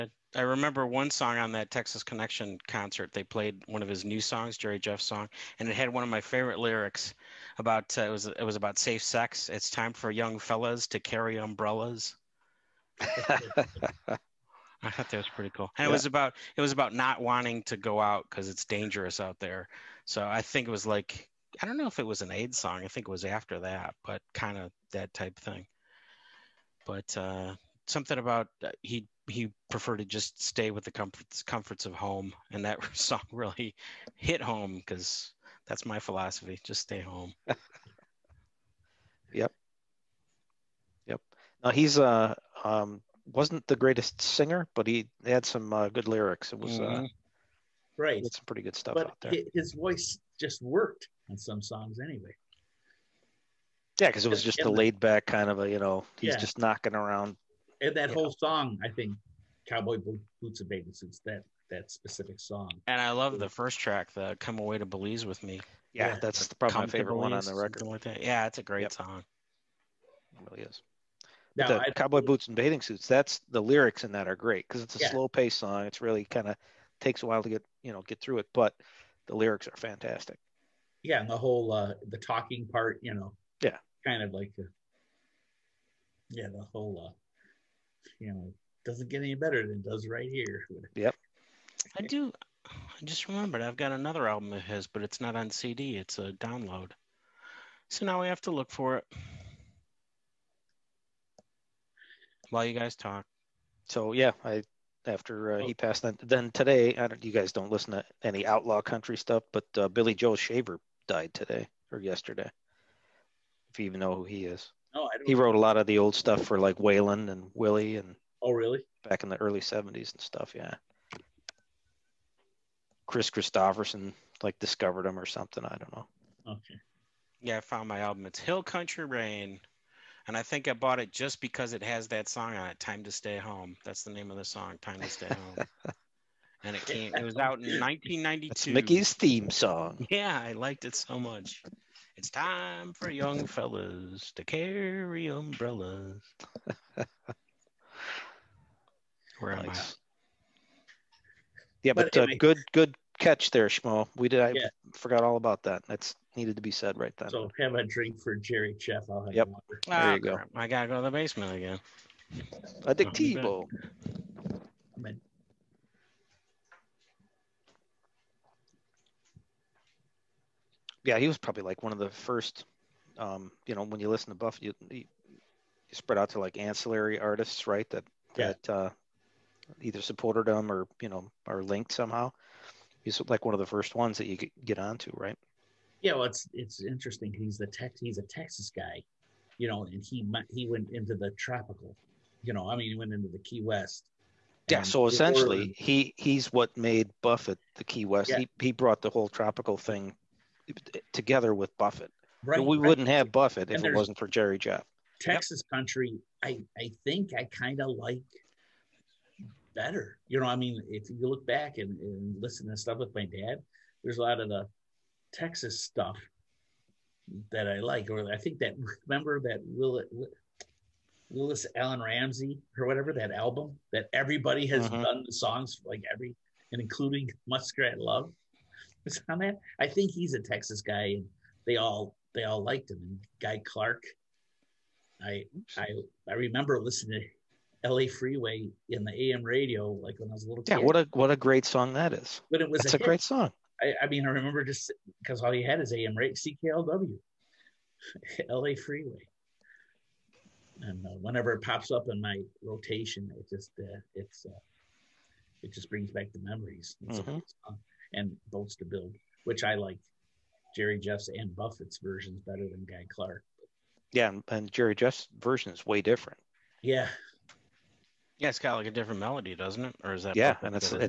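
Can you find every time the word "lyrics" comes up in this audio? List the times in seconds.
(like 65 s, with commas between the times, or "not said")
6 s, 46 s, 73 s, 79 s.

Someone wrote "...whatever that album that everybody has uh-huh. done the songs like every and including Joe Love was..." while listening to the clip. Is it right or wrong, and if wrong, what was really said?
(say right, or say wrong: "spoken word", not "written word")
wrong: "Muskrat", not "Joe".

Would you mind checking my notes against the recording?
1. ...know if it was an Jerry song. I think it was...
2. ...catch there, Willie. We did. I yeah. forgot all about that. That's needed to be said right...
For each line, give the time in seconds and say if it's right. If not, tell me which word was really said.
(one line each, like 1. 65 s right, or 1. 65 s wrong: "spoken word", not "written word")
1. 21 s wrong: "AIDS", not "Jerry"
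2. 153 s wrong: "Schmo", not "Willie".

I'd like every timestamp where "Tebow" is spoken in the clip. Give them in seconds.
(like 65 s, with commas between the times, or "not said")
163 s.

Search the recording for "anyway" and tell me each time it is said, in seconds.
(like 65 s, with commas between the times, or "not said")
51 s, 152 s.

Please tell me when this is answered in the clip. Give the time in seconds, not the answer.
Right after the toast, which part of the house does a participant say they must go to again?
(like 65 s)
161 s.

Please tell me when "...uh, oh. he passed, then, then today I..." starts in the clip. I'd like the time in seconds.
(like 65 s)
105 s.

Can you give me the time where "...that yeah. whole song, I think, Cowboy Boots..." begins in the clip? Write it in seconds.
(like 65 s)
57 s.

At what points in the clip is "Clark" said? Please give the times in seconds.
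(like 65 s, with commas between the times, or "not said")
233 s, 263 s.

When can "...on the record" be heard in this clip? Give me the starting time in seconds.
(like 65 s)
67 s.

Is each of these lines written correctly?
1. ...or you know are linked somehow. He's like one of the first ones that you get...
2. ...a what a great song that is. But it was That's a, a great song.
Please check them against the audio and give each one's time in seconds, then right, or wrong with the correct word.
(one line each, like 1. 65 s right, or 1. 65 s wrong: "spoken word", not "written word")
1. 180 s right
2. 240 s right.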